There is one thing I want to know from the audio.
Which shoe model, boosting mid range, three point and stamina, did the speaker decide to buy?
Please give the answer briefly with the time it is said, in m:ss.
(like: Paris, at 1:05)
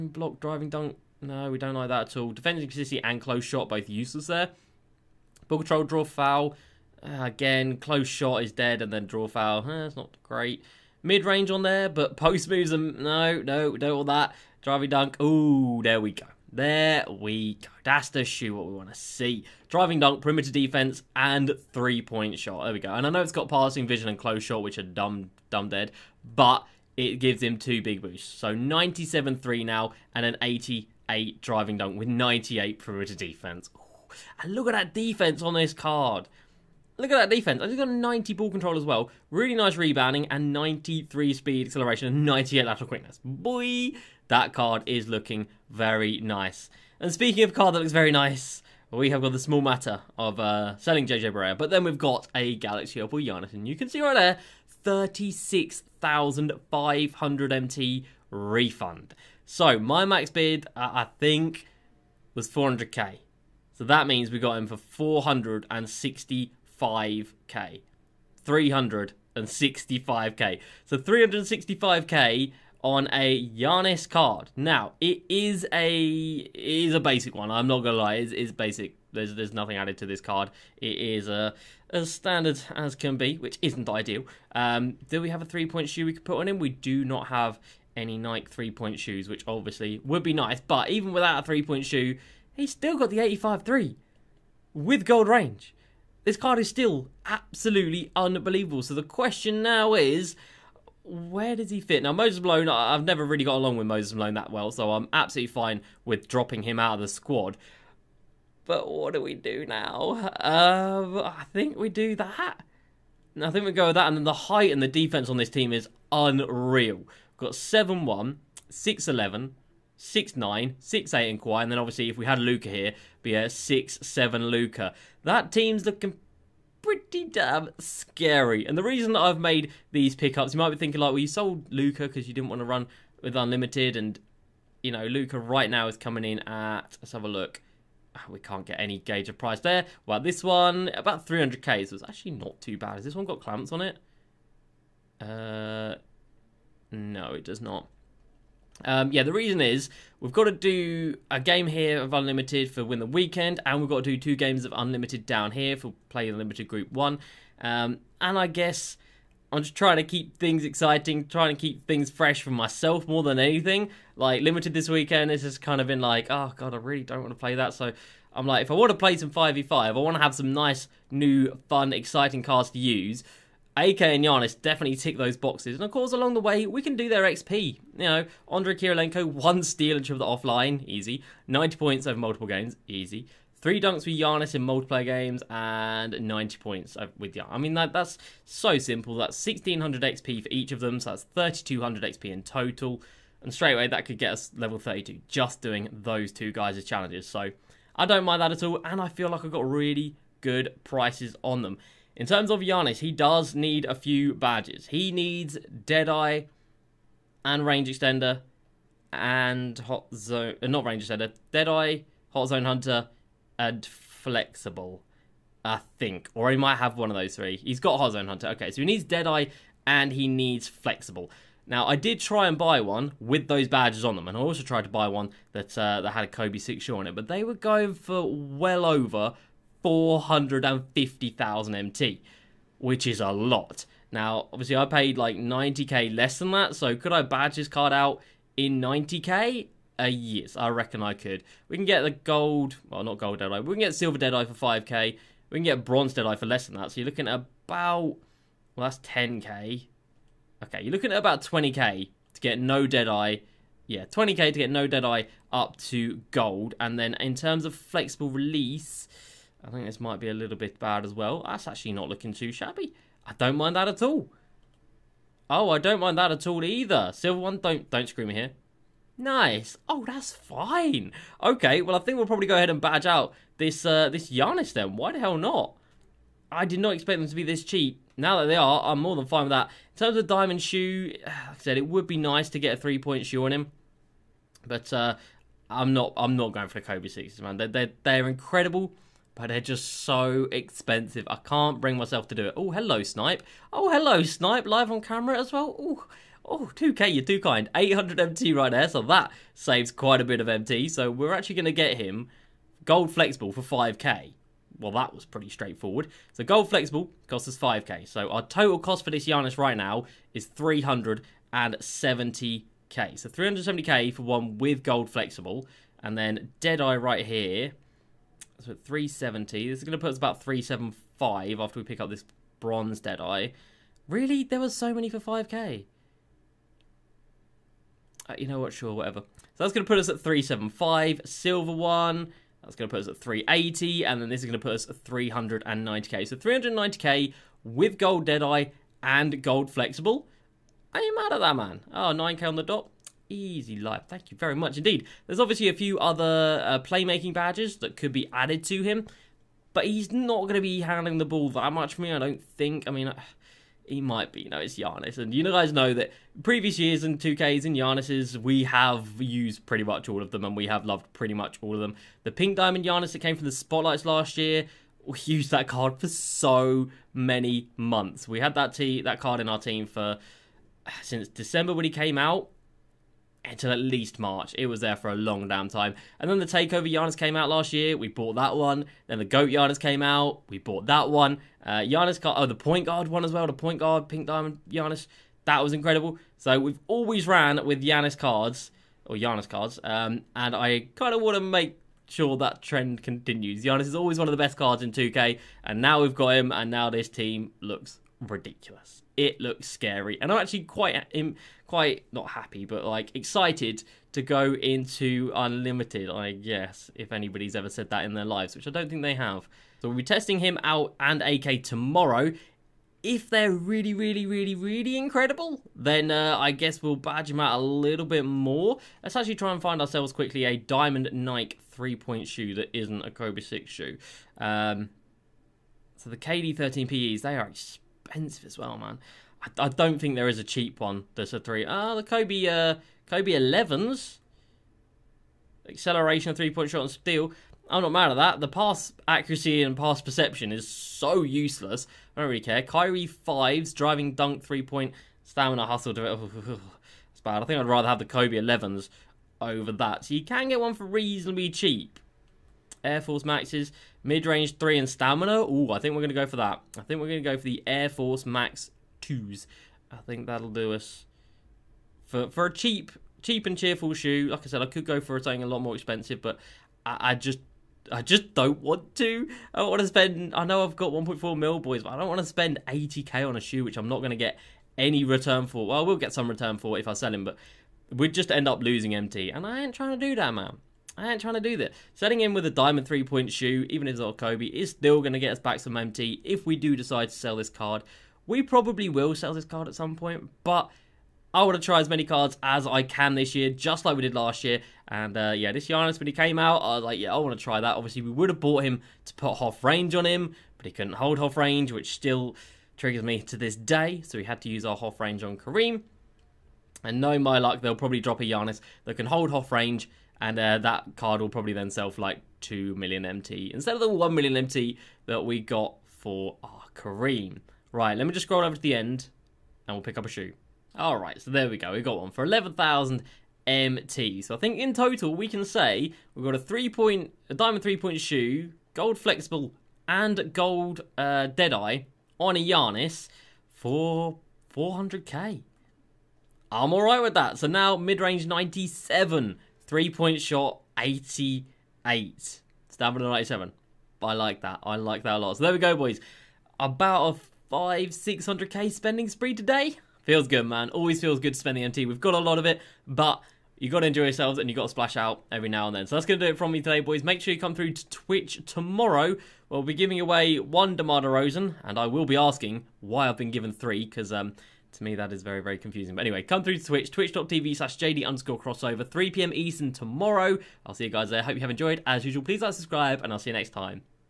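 Air Force Max 2, at 7:37.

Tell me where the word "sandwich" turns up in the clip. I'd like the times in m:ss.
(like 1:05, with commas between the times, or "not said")
not said.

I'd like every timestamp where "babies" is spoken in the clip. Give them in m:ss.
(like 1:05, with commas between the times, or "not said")
not said.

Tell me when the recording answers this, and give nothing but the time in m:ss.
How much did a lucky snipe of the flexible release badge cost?
4:57.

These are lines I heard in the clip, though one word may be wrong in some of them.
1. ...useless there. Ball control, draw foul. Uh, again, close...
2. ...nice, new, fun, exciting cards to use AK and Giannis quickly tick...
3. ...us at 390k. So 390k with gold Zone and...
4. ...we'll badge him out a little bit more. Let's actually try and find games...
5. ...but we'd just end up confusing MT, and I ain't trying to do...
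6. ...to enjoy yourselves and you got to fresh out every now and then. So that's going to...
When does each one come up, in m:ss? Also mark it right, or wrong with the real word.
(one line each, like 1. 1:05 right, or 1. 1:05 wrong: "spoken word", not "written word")
1. 0:03 right
2. 2:50 wrong: "definitely", not "quickly"
3. 5:34 wrong: "Deadeye", not "Zone"
4. 6:56 wrong: "ourselves", not "games"
5. 7:57 wrong: "losing", not "confusing"
6. 9:13 wrong: "splash", not "fresh".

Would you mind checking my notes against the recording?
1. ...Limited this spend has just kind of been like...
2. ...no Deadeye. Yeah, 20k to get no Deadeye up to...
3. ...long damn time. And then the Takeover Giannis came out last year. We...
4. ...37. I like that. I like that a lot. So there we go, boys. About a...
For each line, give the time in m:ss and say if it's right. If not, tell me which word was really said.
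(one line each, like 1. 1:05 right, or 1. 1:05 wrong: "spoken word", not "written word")
1. 2:44 wrong: "weekend", not "spend"
2. 4:12 right
3. 6:15 right
4. 9:03 wrong: "97", not "37".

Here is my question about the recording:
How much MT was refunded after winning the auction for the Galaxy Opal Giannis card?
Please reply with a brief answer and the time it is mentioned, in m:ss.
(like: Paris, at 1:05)
36,500 MT, at 0:54.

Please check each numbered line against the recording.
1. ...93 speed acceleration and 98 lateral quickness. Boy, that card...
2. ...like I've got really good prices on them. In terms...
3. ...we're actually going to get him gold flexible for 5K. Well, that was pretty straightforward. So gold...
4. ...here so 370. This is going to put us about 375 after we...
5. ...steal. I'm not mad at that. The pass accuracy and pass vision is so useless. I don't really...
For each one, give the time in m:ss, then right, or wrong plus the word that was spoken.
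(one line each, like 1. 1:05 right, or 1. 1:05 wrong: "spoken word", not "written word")
1. 0:40 right
2. 3:19 right
3. 5:01 right
4. 5:17 right
5. 7:16 wrong: "perception", not "vision".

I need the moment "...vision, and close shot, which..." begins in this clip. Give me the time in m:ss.
0:23.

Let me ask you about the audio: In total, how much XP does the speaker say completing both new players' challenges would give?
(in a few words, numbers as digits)
3200 XP.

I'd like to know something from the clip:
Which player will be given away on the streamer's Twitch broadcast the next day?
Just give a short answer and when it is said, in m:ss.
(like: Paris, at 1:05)
DeMar DeRozan, at 9:20.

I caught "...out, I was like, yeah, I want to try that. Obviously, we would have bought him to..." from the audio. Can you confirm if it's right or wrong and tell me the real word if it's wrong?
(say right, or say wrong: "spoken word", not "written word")
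right.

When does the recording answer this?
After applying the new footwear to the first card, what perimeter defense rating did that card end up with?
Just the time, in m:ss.
0:32.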